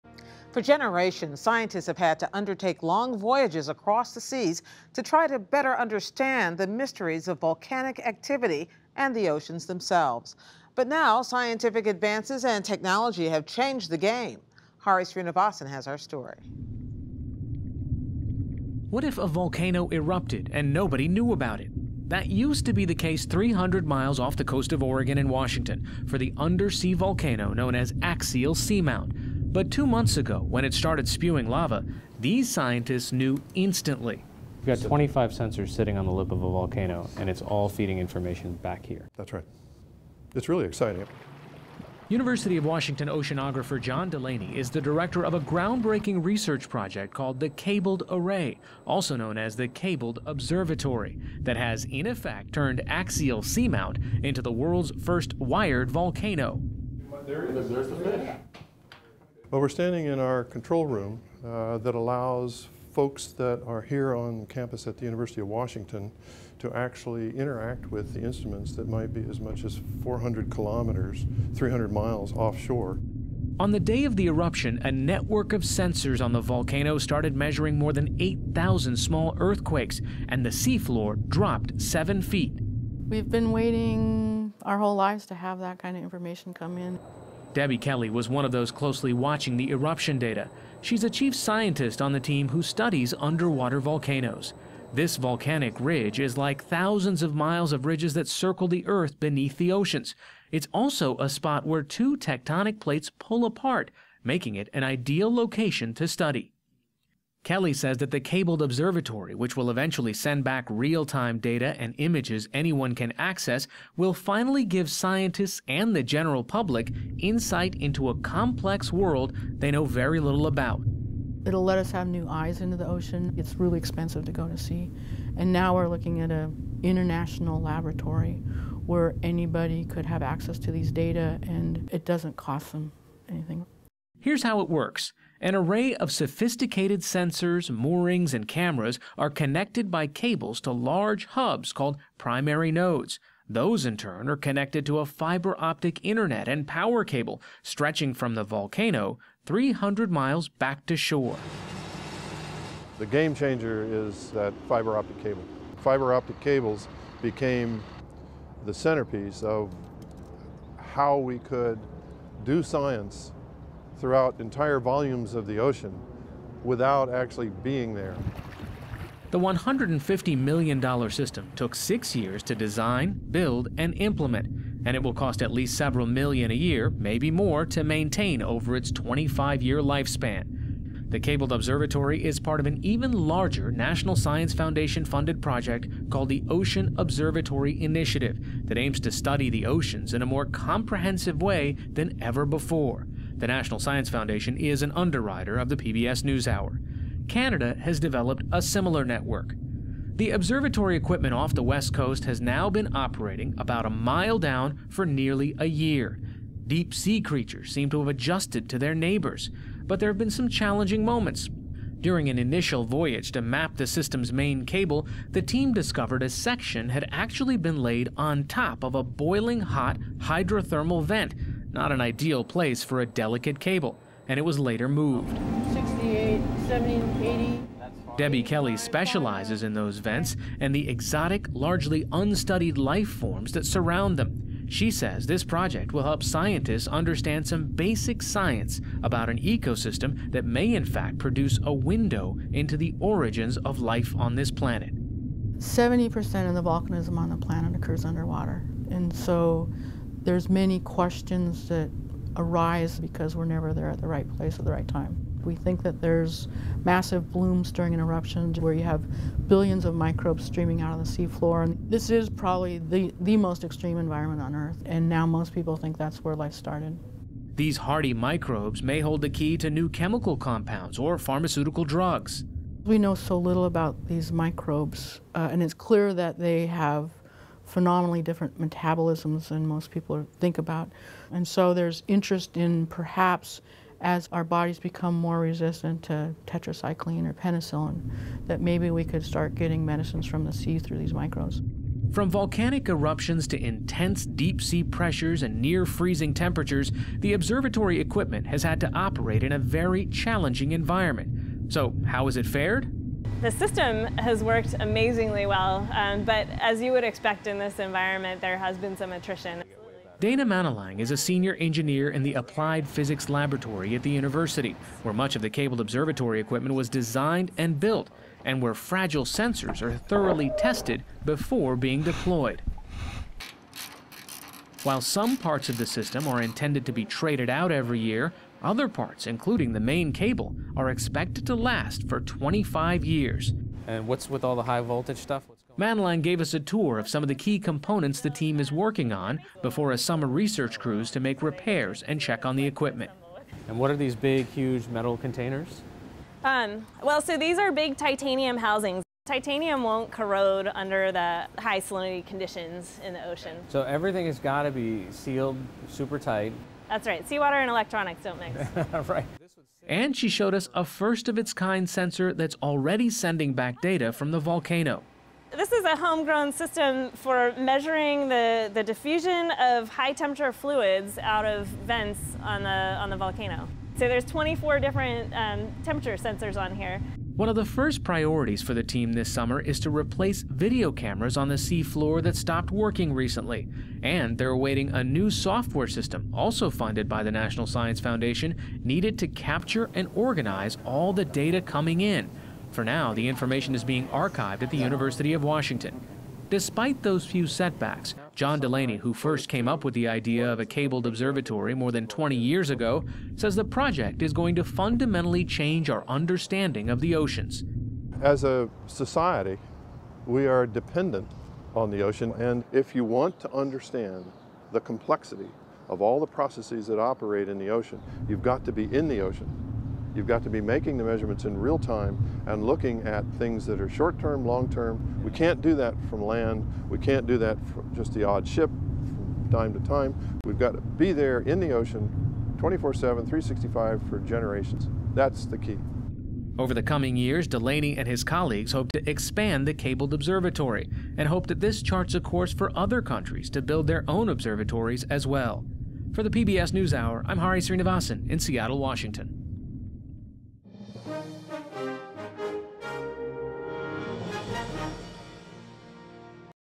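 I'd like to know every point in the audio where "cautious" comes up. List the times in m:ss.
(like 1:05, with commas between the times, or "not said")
not said.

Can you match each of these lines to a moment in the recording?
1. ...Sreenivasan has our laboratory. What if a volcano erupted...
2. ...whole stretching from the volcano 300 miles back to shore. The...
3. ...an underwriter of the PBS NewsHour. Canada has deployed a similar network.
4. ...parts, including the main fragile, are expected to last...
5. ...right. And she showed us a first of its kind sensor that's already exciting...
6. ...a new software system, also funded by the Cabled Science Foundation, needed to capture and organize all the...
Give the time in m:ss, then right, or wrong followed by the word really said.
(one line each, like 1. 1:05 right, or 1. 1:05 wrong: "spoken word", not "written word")
1. 0:15 wrong: "story", not "laboratory"
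2. 2:27 wrong: "cable", not "whole"
3. 3:14 wrong: "developed", not "deployed"
4. 5:28 wrong: "cable", not "fragile"
5. 5:59 wrong: "sending", not "exciting"
6. 6:24 wrong: "National", not "Cabled".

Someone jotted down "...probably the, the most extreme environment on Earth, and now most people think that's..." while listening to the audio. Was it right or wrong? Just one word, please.
right.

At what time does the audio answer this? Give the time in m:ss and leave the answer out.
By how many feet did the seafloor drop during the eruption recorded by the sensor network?
1:21.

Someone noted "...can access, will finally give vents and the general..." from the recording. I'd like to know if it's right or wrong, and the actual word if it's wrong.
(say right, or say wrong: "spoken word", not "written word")
wrong: "scientists", not "vents".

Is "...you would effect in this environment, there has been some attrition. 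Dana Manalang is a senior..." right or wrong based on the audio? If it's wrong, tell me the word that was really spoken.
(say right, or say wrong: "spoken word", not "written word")
wrong: "expect", not "effect".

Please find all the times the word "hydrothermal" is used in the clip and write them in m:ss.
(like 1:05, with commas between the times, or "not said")
3:40.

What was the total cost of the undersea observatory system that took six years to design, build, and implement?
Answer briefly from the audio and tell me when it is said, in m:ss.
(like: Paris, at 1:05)
$150 million, at 2:49.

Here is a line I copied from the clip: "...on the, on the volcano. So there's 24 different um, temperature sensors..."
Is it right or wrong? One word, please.
right.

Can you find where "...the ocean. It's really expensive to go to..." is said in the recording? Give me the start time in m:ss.
2:02.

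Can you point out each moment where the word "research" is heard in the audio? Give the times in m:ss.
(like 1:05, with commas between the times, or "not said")
0:46, 5:40.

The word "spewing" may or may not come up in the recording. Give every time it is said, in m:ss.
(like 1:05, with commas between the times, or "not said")
0:31.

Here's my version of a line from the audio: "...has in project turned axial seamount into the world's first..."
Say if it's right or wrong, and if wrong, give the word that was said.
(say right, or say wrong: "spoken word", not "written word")
wrong: "effect", not "project".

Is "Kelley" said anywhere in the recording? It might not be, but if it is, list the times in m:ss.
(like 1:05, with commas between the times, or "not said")
1:27, 1:47, 3:48.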